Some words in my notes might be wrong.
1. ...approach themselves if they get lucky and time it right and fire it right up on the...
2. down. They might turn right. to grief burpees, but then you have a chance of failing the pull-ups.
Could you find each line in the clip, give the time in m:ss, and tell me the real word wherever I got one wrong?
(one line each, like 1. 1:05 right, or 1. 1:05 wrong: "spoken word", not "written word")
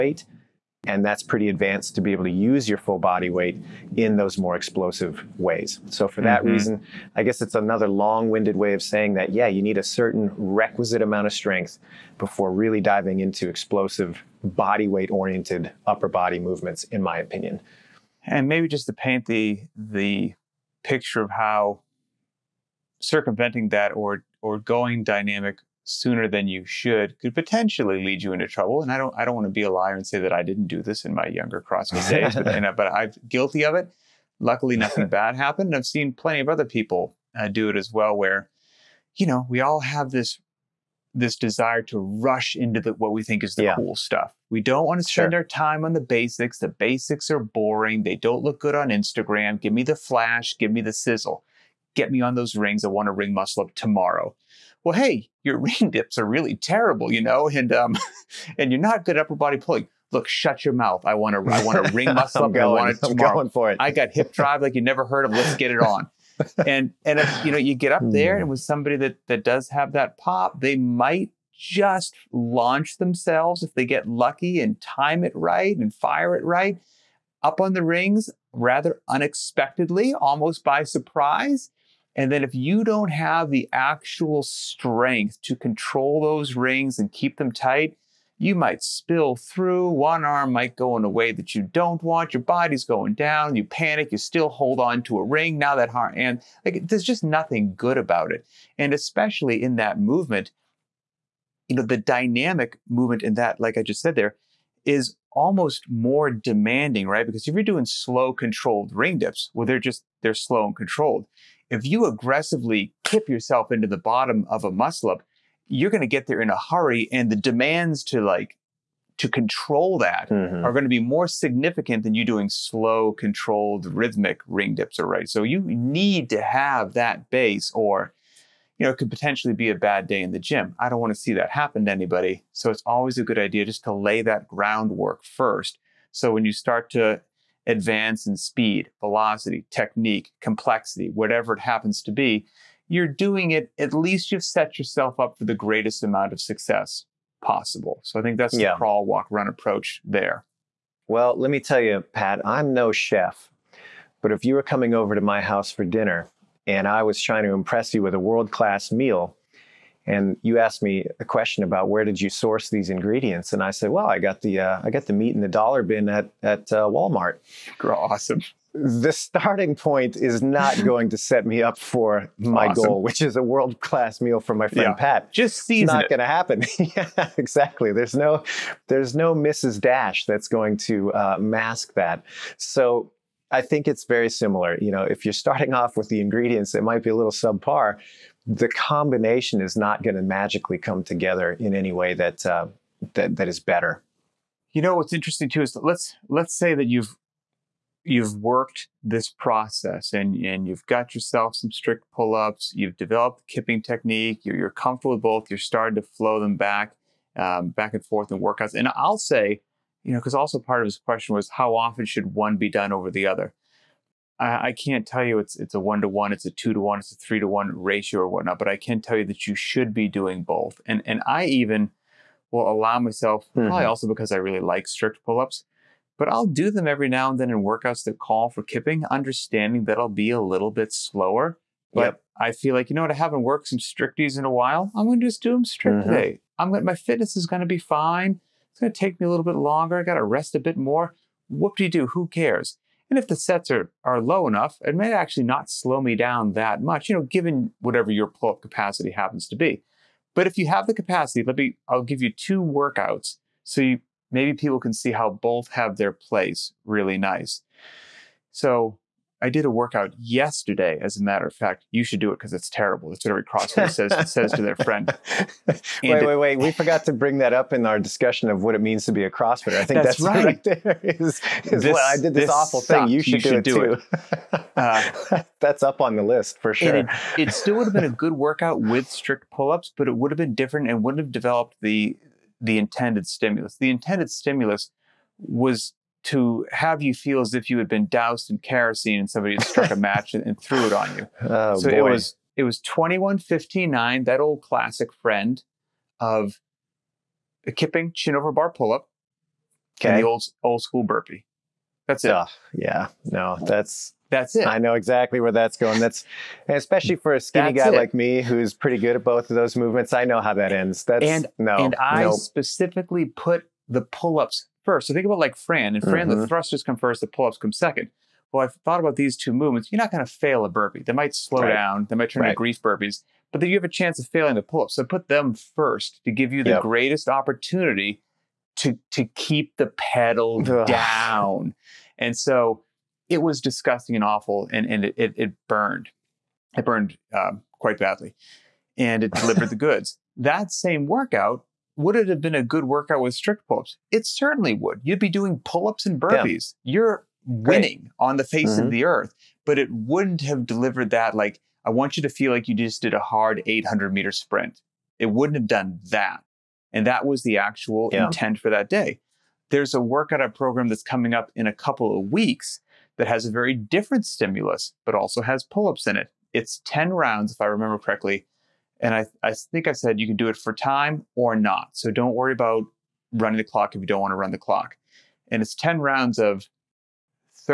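1. 1:12 wrong: "launch", not "approach"
2. 5:21 right.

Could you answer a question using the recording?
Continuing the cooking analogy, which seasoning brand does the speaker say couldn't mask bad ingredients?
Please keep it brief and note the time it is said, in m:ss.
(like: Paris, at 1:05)
Mrs. Dash, at 2:59.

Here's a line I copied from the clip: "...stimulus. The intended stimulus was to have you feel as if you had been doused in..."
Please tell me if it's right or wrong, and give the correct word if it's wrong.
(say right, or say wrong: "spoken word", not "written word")
right.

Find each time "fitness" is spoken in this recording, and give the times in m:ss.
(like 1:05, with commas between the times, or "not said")
3:56.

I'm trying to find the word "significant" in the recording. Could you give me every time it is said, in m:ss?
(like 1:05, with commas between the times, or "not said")
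2:01.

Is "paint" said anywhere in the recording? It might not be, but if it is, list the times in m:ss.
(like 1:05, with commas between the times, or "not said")
0:18.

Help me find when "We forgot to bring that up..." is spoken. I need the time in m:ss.
4:26.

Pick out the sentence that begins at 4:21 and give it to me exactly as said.
As a matter of fact, you should do it because it's terrible.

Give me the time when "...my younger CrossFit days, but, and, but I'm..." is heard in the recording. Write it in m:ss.
0:31.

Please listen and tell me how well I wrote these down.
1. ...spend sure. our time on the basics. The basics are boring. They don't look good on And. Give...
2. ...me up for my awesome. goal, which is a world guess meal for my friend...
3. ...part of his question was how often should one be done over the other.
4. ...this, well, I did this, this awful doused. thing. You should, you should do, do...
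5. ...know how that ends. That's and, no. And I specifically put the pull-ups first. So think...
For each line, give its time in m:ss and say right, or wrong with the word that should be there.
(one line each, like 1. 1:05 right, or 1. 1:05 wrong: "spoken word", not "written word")
1. 0:45 wrong: "Instagram", not "And"
2. 2:51 wrong: "class", not "guess"
3. 3:30 right
4. 4:31 wrong: "sucked", not "doused"
5. 5:10 right.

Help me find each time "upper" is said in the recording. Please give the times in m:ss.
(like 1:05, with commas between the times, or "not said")
0:15, 0:59.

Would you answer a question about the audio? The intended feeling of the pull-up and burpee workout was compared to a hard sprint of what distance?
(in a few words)
800 meters.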